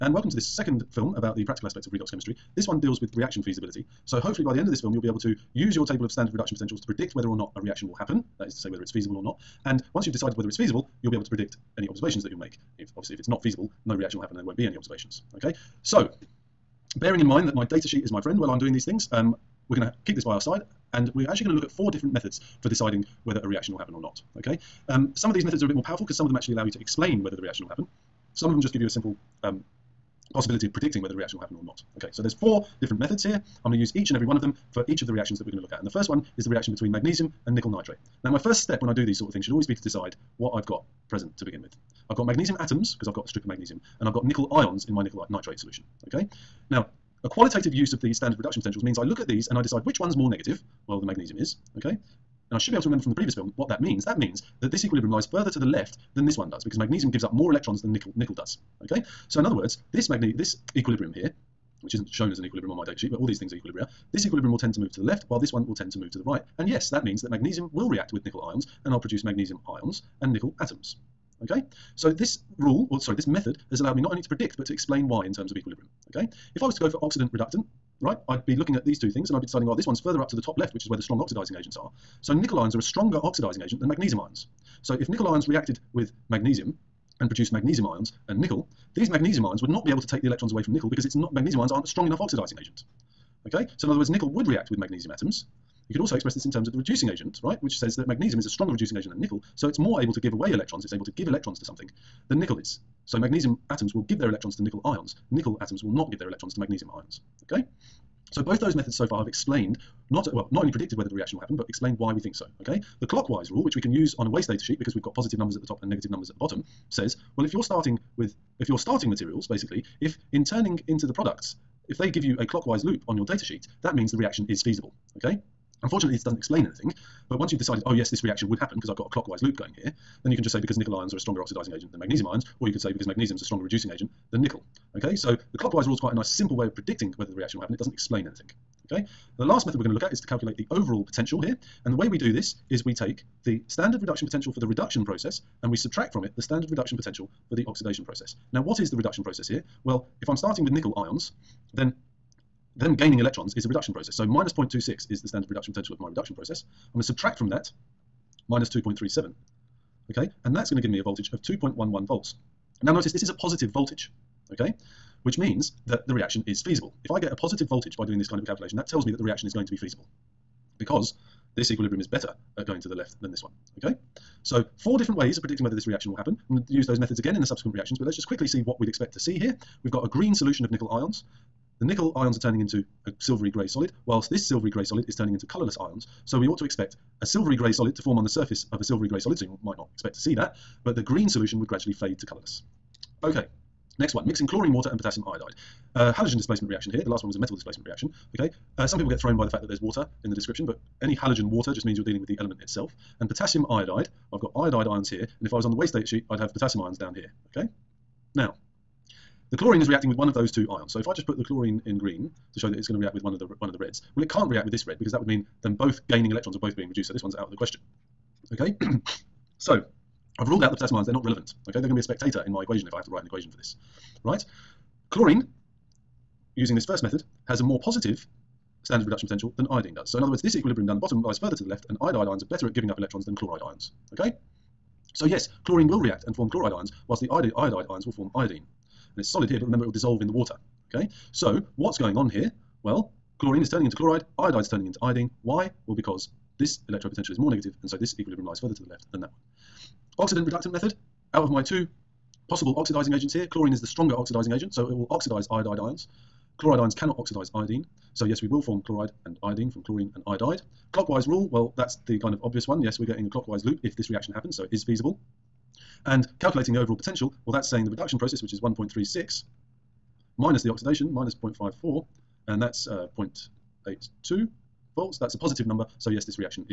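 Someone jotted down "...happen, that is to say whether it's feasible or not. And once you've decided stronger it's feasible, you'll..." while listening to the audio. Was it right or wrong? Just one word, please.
wrong.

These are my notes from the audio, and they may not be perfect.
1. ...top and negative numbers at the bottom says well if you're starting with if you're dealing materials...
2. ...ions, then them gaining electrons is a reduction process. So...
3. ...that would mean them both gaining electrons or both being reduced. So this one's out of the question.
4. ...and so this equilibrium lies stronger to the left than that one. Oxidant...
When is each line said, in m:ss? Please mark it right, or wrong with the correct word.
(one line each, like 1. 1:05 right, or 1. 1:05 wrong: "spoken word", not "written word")
1. 1:55 wrong: "starting", not "dealing"
2. 2:30 right
3. 3:35 right
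4. 4:07 wrong: "further", not "stronger".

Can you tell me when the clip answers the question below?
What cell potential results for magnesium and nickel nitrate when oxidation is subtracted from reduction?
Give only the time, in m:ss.
2:41.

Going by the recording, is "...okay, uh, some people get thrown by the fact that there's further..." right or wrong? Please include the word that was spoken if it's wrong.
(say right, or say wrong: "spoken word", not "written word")
wrong: "water", not "further".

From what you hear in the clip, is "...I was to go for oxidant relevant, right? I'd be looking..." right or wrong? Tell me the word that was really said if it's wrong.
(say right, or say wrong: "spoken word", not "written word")
wrong: "reductant", not "relevant".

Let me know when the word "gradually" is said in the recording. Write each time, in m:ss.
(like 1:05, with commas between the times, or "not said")
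3:11.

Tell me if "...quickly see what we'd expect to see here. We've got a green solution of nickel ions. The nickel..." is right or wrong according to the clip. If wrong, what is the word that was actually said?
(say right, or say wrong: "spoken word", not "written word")
right.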